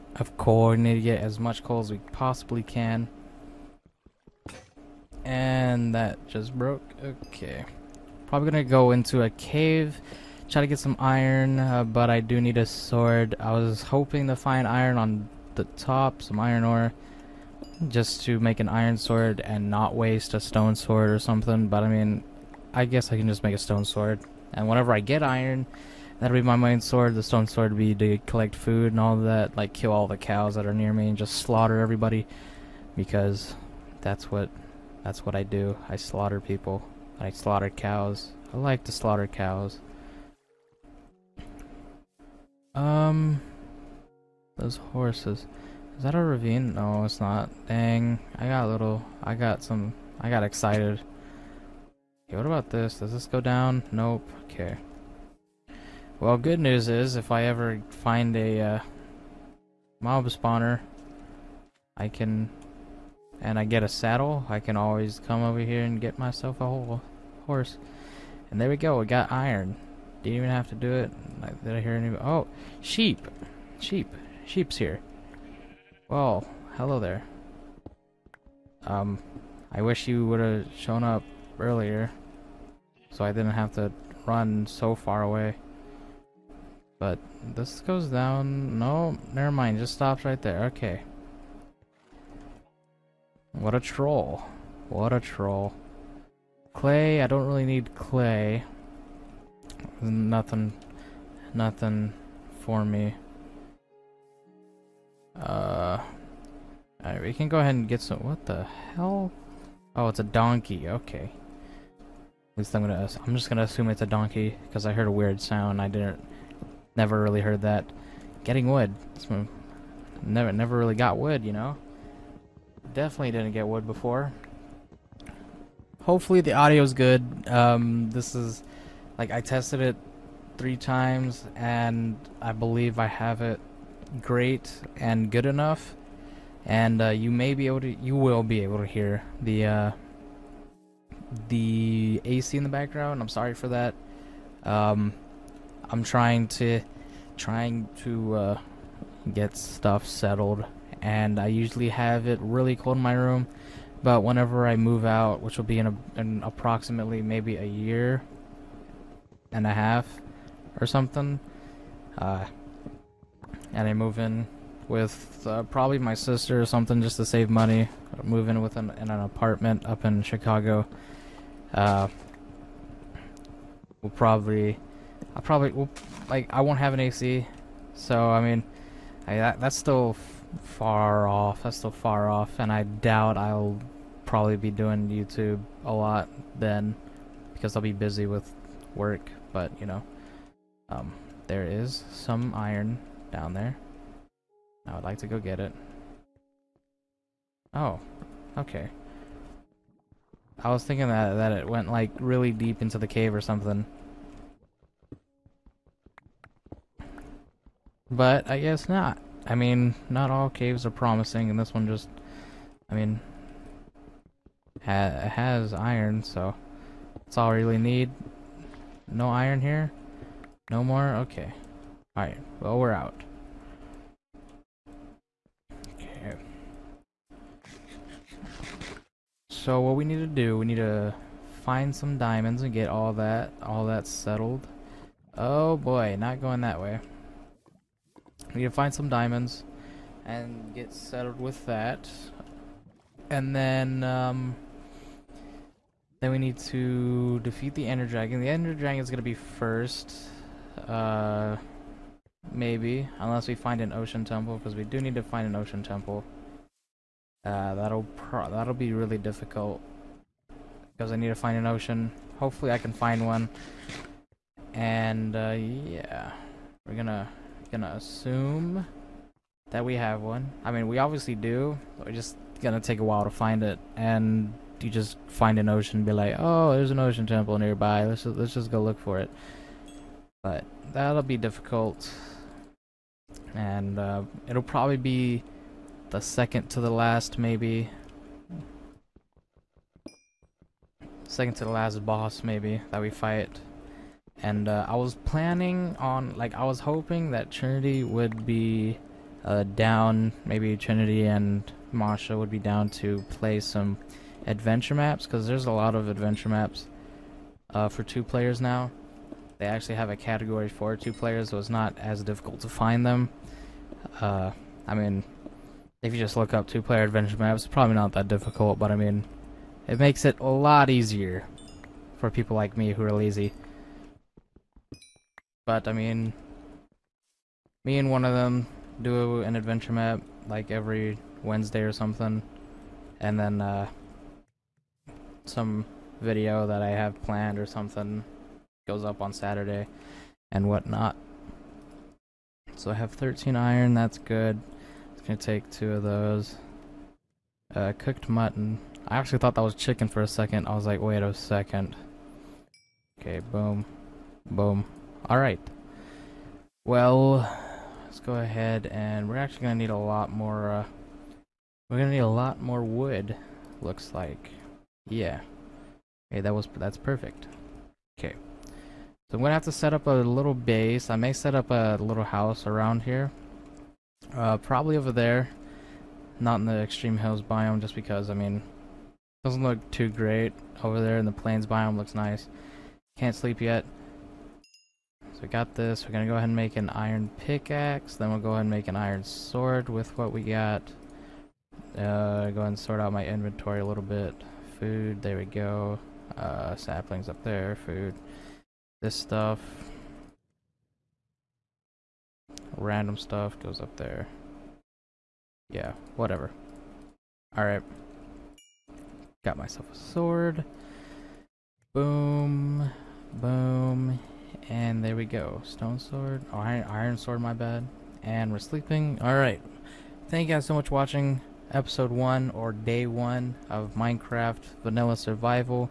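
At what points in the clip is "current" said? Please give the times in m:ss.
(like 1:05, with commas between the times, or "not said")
not said.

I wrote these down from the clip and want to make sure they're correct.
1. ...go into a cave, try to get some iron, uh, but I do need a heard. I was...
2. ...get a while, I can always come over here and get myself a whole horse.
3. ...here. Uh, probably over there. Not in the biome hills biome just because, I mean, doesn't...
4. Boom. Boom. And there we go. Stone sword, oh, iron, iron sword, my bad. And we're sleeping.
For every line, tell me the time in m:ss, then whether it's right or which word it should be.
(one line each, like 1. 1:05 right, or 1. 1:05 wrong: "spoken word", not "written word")
1. 0:08 wrong: "sword", not "heard"
2. 1:03 wrong: "saddle", not "while"
3. 6:13 wrong: "extreme", not "biome"
4. 6:51 right.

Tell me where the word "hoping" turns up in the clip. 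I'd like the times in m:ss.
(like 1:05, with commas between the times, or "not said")
0:13, 4:56.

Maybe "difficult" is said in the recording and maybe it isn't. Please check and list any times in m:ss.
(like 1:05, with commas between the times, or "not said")
4:19, 4:41, 5:12, 5:18.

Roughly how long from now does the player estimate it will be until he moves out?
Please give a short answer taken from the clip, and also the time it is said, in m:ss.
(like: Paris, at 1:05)
a year and a half, at 2:37.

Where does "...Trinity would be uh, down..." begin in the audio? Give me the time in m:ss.
4:57.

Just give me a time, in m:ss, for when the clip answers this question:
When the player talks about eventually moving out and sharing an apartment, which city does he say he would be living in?
2:50.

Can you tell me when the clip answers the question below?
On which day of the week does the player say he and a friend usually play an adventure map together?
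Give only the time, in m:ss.
5:31.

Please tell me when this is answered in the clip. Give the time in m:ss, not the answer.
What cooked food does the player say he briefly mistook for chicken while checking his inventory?
5:47.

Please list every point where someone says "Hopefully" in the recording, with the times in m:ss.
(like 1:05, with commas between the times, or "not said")
2:06, 4:22.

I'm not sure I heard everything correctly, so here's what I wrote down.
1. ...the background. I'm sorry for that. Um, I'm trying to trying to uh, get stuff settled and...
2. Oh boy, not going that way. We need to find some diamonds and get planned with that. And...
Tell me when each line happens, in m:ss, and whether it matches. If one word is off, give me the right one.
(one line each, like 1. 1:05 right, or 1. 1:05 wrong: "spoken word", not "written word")
1. 2:22 right
2. 3:55 wrong: "settled", not "planned".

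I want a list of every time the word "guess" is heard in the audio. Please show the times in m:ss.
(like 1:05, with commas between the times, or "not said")
0:22, 3:28.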